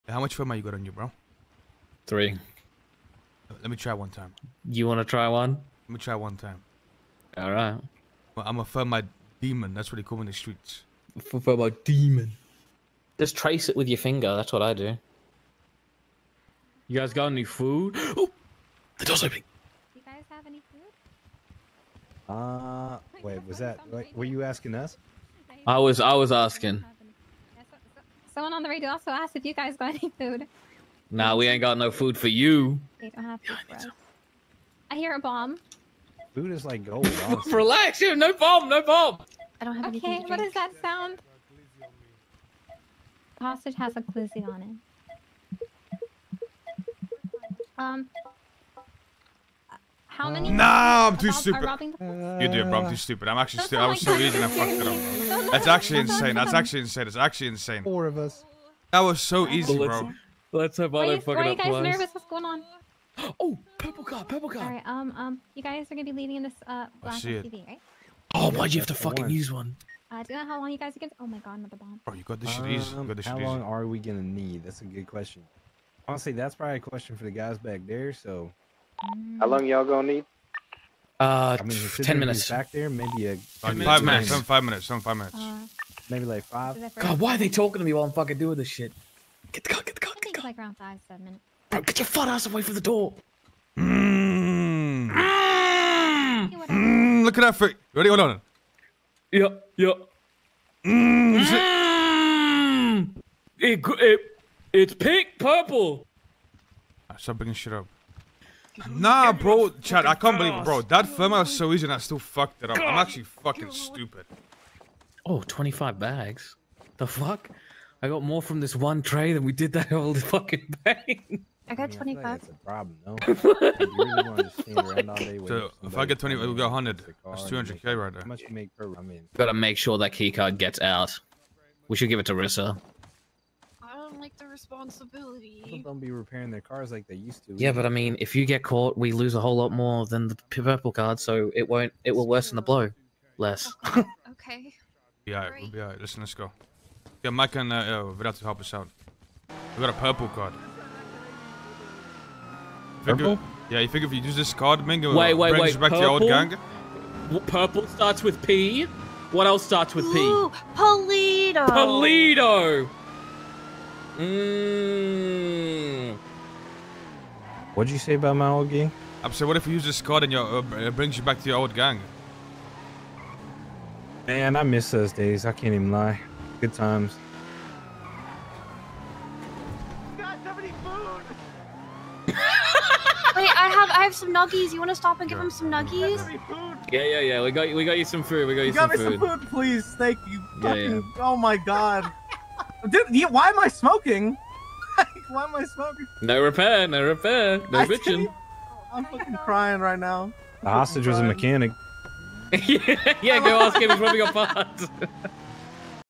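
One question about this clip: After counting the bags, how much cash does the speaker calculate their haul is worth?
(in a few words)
200k.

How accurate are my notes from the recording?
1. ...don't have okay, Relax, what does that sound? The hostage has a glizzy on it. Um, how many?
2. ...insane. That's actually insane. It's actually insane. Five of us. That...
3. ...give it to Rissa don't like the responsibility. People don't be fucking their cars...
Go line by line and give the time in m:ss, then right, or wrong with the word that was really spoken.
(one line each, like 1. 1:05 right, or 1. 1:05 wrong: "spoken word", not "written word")
1. 0:39 wrong: "Okay", not "Relax"
2. 0:56 wrong: "Four", not "Five"
3. 2:12 wrong: "repairing", not "fucking".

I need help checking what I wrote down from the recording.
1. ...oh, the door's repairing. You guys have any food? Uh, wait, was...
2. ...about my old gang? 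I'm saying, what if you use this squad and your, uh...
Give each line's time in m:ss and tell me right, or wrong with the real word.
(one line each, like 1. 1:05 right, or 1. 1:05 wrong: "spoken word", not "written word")
1. 0:17 wrong: "opening", not "repairing"
2. 2:48 right.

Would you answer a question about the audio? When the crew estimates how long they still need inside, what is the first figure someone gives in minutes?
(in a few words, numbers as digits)
10 minutes.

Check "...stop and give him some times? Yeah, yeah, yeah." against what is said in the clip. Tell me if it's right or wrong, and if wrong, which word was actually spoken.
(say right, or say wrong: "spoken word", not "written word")
wrong: "nuggies", not "times".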